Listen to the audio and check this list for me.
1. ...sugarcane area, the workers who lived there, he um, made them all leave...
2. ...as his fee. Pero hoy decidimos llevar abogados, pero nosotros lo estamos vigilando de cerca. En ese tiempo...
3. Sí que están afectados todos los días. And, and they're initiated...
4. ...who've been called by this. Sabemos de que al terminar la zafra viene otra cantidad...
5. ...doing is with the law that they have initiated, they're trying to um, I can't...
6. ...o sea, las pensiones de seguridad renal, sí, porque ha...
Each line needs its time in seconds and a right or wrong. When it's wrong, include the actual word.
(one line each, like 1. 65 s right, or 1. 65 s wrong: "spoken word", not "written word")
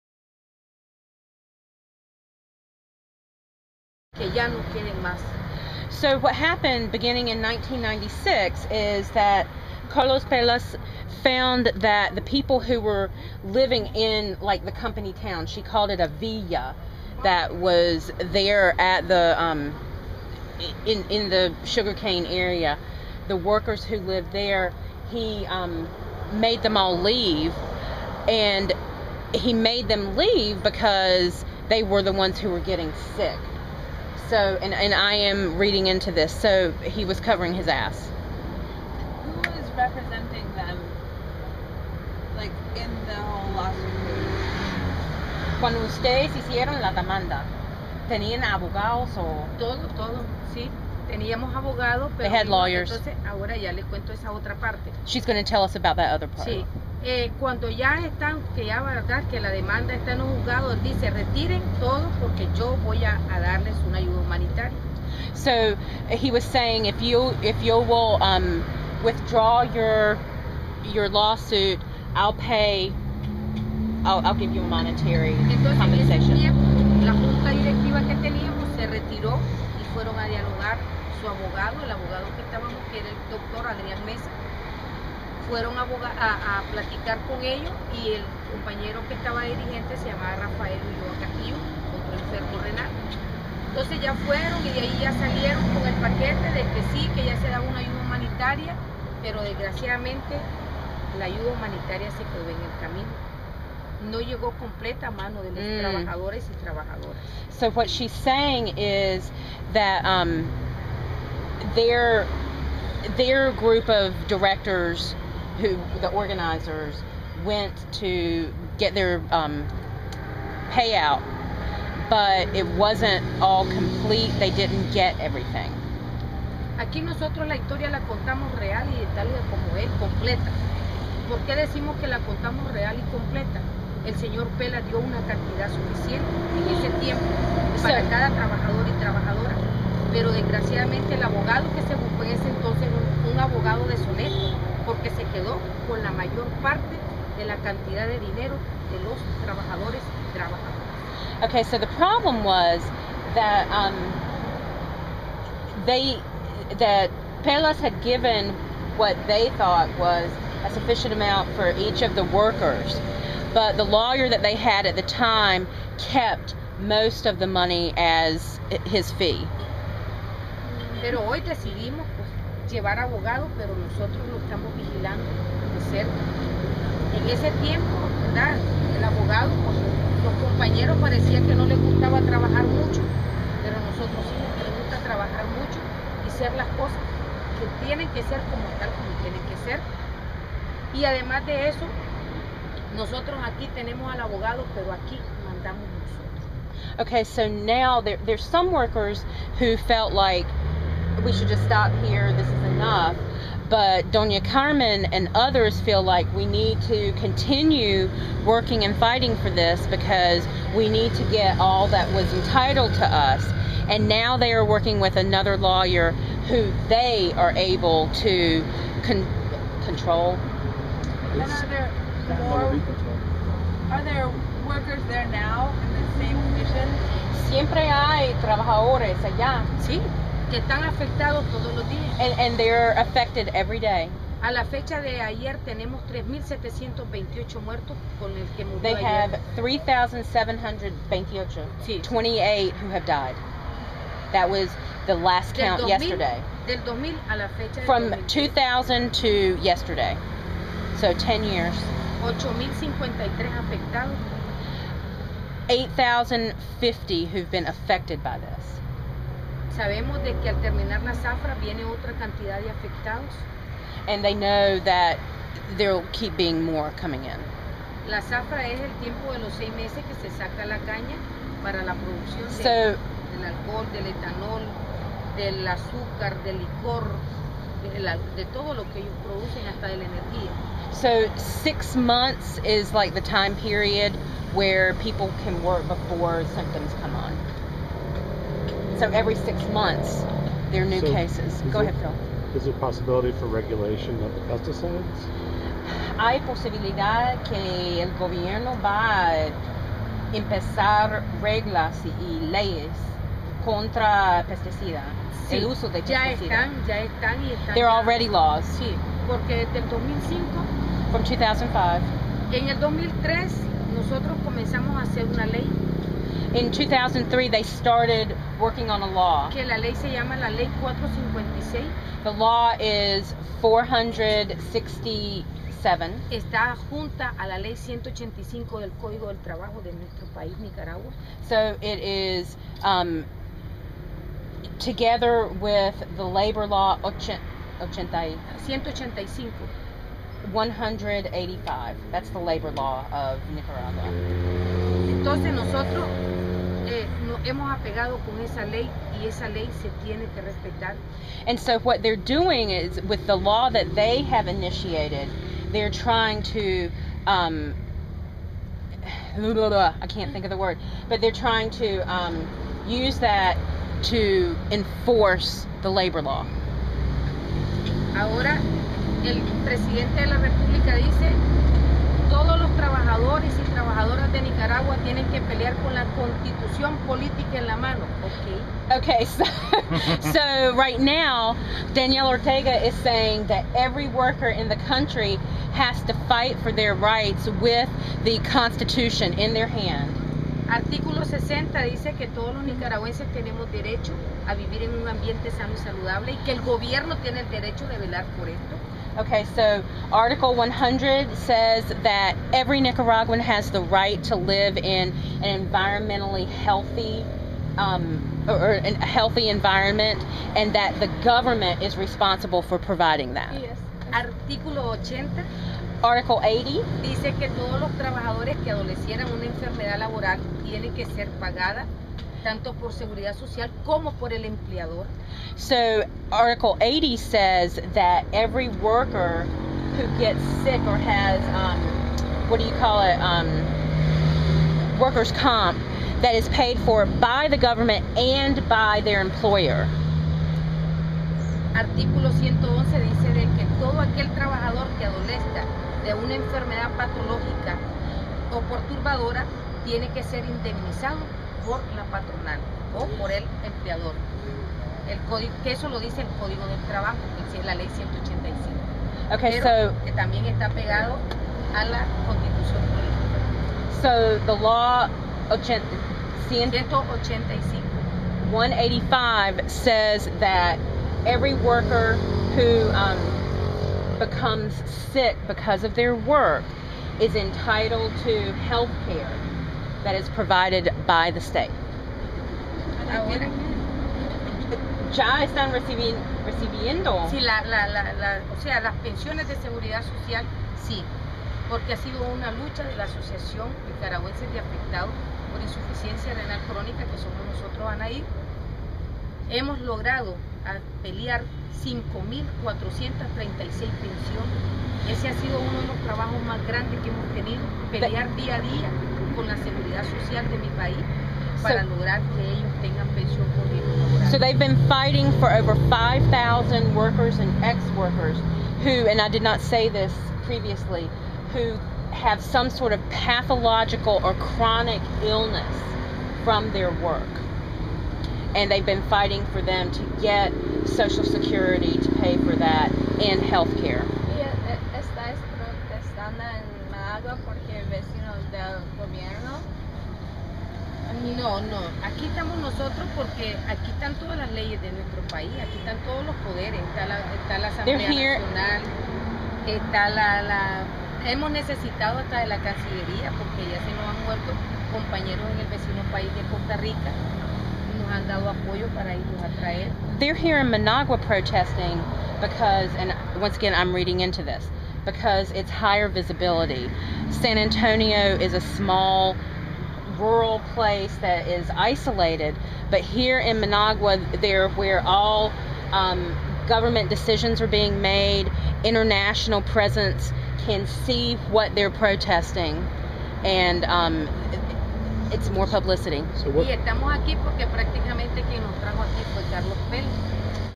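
1. 21 s right
2. 167 s right
3. 229 s wrong: "affected", not "initiated"
4. 257 s wrong: "affected", not "called"
5. 352 s right
6. 488 s wrong: "social", not "renal".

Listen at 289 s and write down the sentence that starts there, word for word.
So every six months, there are new So, cases.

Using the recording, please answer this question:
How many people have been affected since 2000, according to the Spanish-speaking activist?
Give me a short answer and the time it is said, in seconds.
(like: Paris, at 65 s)
8,053, at 252 s.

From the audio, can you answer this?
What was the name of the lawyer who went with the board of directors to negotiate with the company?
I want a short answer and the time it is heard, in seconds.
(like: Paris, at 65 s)
Adrián Mesa, at 83 s.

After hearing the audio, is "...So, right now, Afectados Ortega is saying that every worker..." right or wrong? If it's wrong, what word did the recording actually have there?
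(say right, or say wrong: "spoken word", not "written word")
wrong: "Daniel", not "Afectados".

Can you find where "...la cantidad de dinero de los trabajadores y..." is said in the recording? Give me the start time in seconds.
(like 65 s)
147 s.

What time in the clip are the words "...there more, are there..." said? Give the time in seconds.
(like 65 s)
221 s.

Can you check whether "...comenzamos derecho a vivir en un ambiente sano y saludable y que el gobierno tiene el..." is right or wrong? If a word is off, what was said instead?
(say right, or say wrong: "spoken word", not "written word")
wrong: "tenemos", not "comenzamos".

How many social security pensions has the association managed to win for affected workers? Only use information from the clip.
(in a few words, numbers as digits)
5,436.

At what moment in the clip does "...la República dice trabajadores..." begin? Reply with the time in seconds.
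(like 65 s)
370 s.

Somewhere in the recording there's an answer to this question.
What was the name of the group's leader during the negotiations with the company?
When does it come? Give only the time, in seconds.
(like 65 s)
90 s.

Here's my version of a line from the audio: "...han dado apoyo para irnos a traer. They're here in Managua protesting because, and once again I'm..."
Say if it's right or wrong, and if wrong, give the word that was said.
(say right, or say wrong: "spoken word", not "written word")
right.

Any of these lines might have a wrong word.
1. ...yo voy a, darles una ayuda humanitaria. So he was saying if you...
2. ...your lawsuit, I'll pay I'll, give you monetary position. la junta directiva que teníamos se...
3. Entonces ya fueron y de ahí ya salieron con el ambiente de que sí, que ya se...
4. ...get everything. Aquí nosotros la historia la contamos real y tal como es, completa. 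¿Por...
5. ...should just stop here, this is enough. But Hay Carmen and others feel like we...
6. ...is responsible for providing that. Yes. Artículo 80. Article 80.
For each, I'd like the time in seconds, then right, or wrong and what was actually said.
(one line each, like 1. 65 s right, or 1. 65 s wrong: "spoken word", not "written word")
1. 62 s right
2. 70 s wrong: "compensation", not "position"
3. 93 s wrong: "paquete", not "ambiente"
4. 124 s right
5. 201 s wrong: "Dona", not "Hay"
6. 411 s right.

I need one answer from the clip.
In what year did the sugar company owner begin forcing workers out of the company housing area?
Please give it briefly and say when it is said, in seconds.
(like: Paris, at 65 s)
1996, at 7 s.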